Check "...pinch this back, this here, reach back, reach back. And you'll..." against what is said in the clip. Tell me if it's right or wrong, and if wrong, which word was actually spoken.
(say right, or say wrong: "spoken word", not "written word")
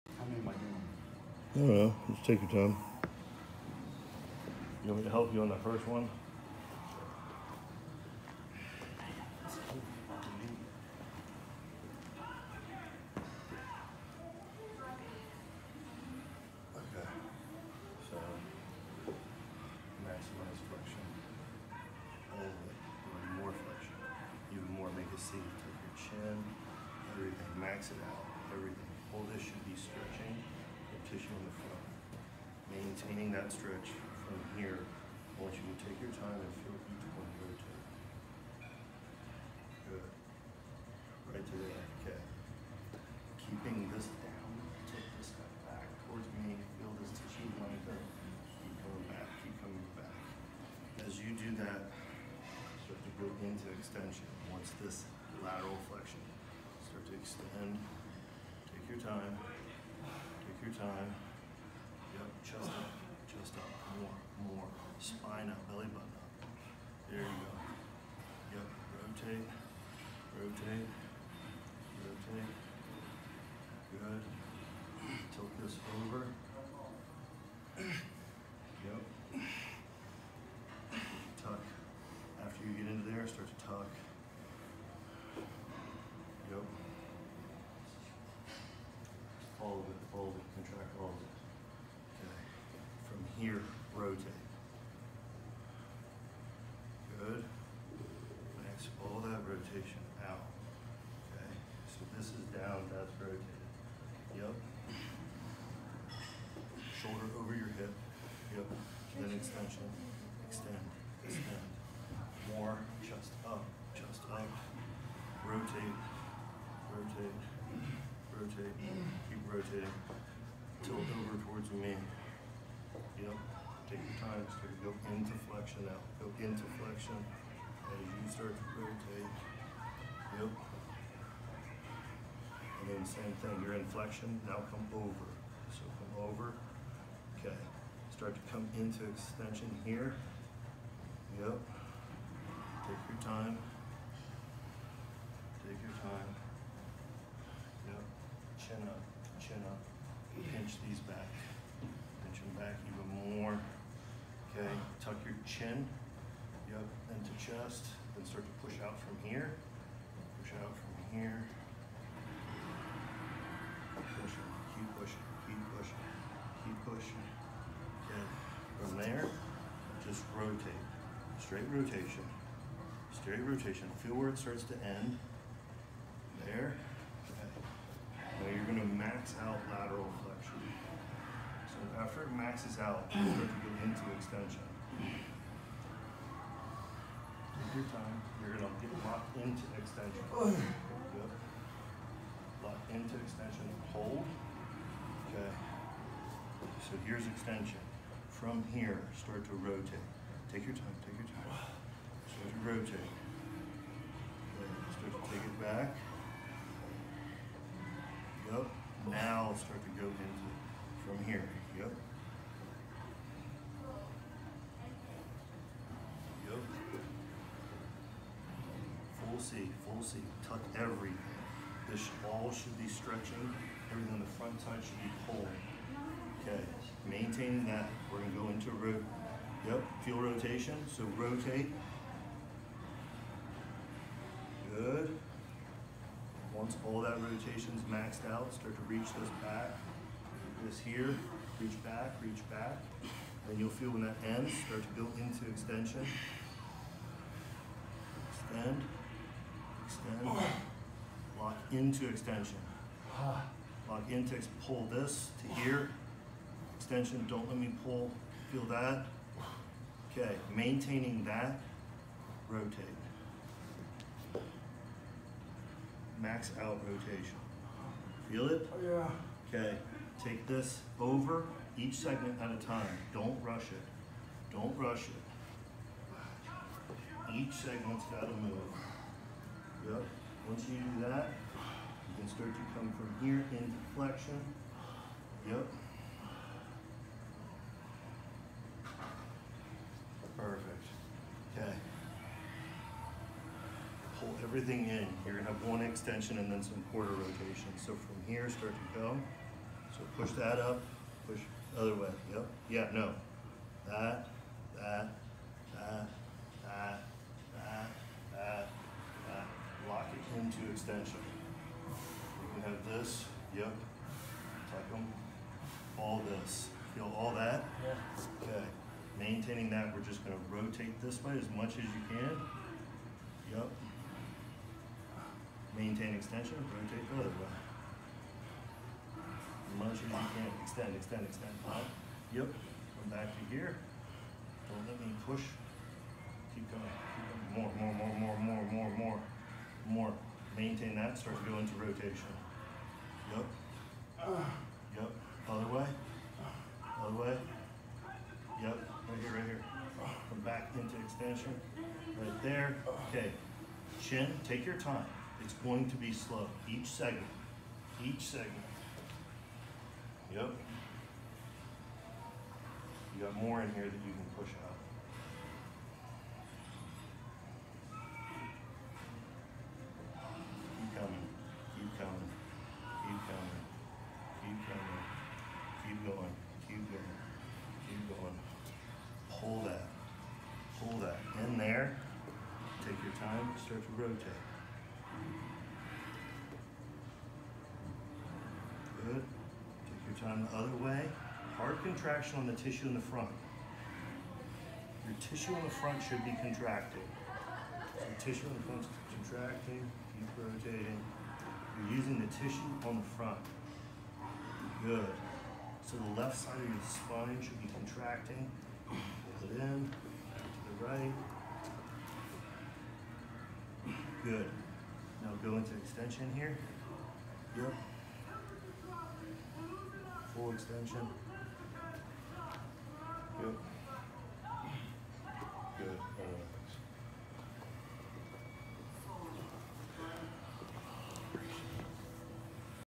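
wrong: "reach", not "pinch".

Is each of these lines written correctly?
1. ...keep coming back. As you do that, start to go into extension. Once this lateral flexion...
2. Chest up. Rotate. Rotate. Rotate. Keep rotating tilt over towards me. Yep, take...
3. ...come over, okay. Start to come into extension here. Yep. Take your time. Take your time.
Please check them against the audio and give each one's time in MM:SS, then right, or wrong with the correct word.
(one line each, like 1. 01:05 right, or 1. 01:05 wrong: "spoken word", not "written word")
1. 00:49 right
2. 01:53 right
3. 02:15 right.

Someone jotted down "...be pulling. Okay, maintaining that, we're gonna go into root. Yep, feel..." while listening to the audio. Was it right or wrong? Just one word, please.
right.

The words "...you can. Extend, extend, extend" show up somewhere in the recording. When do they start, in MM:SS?
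05:30.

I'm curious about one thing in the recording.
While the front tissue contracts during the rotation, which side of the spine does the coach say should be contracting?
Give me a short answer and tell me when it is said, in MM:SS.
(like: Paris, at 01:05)
left side, at 06:46.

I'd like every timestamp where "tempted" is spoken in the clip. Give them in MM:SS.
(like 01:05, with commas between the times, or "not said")
not said.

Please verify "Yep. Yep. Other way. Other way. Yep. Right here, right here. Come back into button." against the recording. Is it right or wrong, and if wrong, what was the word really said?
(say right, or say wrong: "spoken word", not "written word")
wrong: "extension", not "button".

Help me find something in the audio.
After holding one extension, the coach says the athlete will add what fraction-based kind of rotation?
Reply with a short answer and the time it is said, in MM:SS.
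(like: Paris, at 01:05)
quarter rotation, at 04:56.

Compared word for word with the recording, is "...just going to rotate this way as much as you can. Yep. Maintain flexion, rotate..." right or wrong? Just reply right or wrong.
wrong.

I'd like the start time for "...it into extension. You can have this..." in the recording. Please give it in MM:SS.
05:10.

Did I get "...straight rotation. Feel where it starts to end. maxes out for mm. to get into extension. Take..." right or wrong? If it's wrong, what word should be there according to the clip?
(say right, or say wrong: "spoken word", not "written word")
right.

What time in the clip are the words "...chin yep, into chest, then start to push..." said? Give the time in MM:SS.
02:35.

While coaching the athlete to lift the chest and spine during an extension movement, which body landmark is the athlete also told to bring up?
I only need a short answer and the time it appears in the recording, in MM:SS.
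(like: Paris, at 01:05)
belly button, at 01:05.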